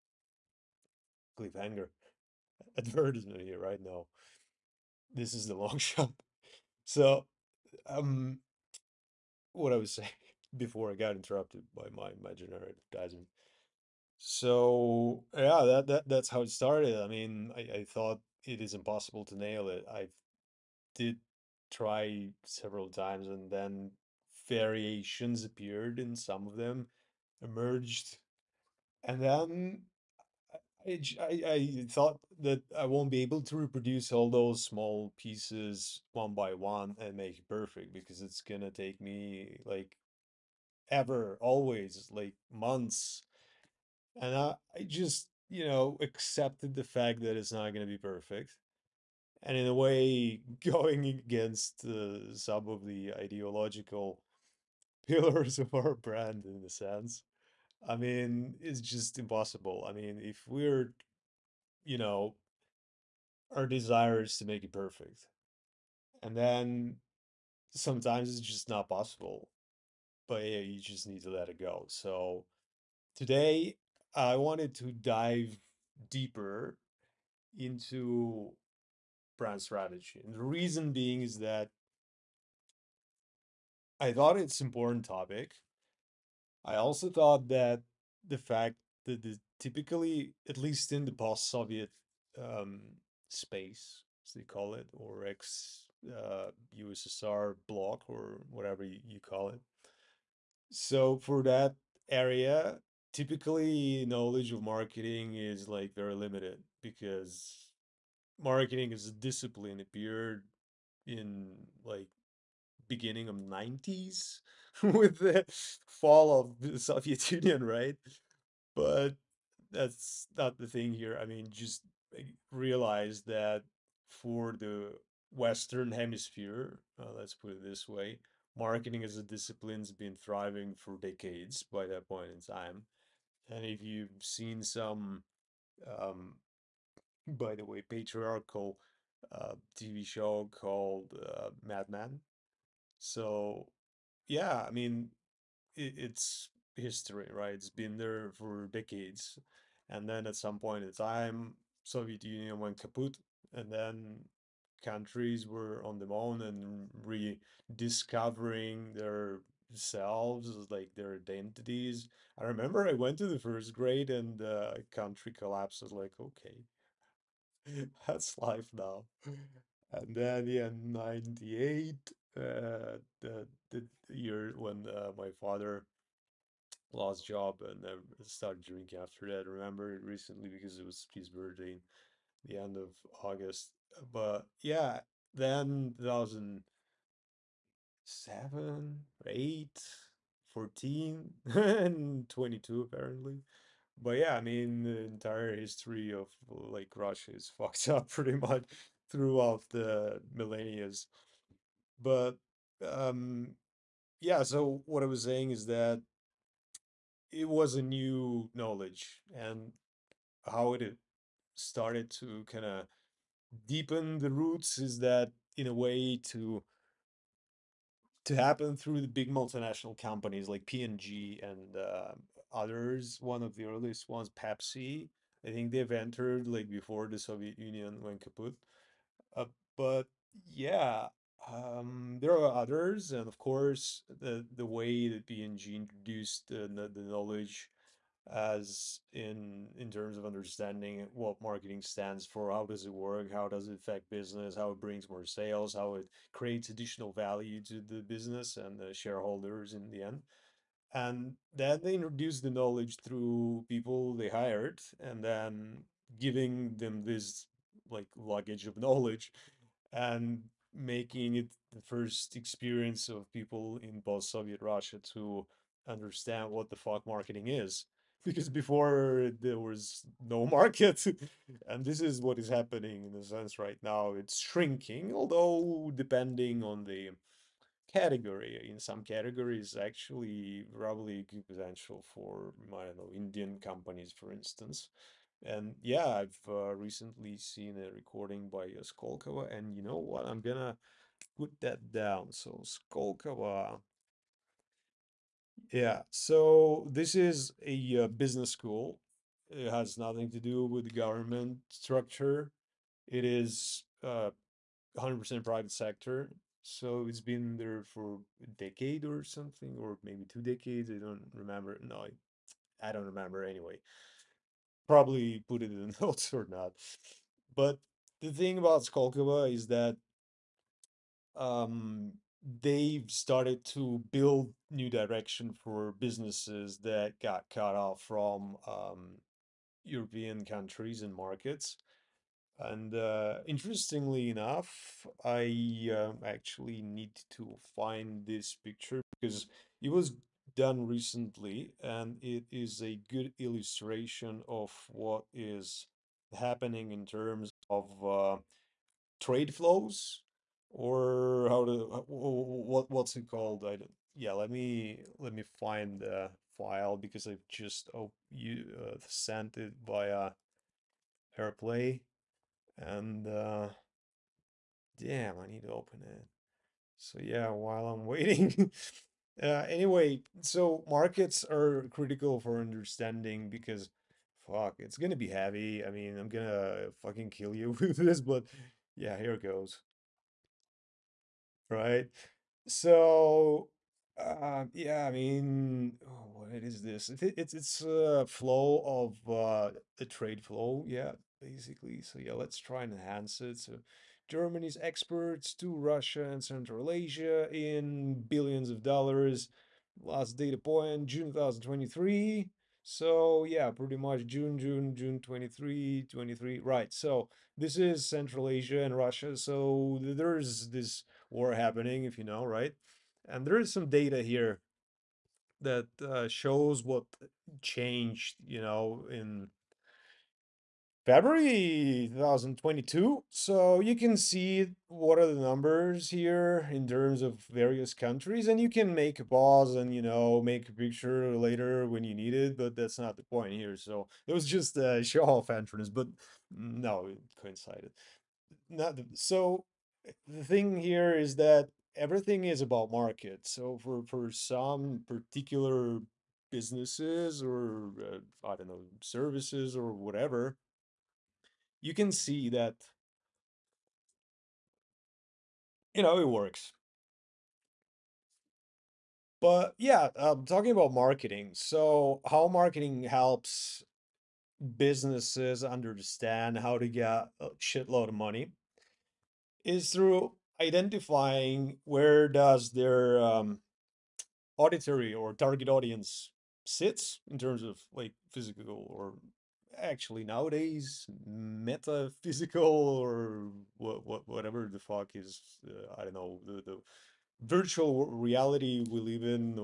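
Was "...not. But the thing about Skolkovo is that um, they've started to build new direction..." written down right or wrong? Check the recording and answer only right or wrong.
right.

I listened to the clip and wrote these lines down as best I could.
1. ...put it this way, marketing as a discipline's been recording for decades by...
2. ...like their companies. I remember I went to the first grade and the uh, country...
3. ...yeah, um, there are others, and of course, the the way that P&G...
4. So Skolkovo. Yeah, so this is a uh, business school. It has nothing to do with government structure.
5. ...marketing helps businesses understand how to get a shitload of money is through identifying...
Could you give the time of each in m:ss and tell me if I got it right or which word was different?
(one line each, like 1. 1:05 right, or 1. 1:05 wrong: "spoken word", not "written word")
1. 2:07 wrong: "thriving", not "recording"
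2. 2:40 wrong: "identities", not "companies"
3. 3:50 right
4. 4:52 right
5. 7:42 right.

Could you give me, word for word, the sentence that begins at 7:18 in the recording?
Not the, so the thing here is that everything is about market.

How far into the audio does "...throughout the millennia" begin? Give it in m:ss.
3:19.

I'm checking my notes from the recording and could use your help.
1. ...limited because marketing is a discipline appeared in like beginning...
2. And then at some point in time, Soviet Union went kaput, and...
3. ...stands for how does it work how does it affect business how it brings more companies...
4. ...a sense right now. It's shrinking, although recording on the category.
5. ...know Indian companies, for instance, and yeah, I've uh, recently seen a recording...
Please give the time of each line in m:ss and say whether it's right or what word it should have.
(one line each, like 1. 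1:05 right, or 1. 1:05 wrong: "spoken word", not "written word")
1. 1:46 right
2. 2:29 right
3. 4:01 wrong: "sales", not "companies"
4. 4:33 wrong: "depending", not "recording"
5. 4:42 right.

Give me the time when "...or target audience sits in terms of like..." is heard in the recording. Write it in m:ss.
7:55.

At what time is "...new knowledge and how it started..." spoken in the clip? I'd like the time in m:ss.
3:27.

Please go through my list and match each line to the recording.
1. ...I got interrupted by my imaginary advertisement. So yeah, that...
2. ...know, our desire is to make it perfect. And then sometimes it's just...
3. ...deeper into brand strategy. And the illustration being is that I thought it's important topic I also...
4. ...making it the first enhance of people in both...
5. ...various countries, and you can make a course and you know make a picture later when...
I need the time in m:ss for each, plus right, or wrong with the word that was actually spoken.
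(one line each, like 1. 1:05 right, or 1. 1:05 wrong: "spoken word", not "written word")
1. 0:10 right
2. 1:01 right
3. 1:16 wrong: "reason", not "illustration"
4. 4:20 wrong: "experience", not "enhance"
5. 7:07 wrong: "pause", not "course".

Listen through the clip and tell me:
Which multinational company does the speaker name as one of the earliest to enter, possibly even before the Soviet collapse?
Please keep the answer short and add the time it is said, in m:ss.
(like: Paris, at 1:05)
Pepsi, at 3:44.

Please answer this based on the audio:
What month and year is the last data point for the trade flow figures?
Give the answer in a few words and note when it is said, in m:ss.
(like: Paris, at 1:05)
June 2023, at 6:41.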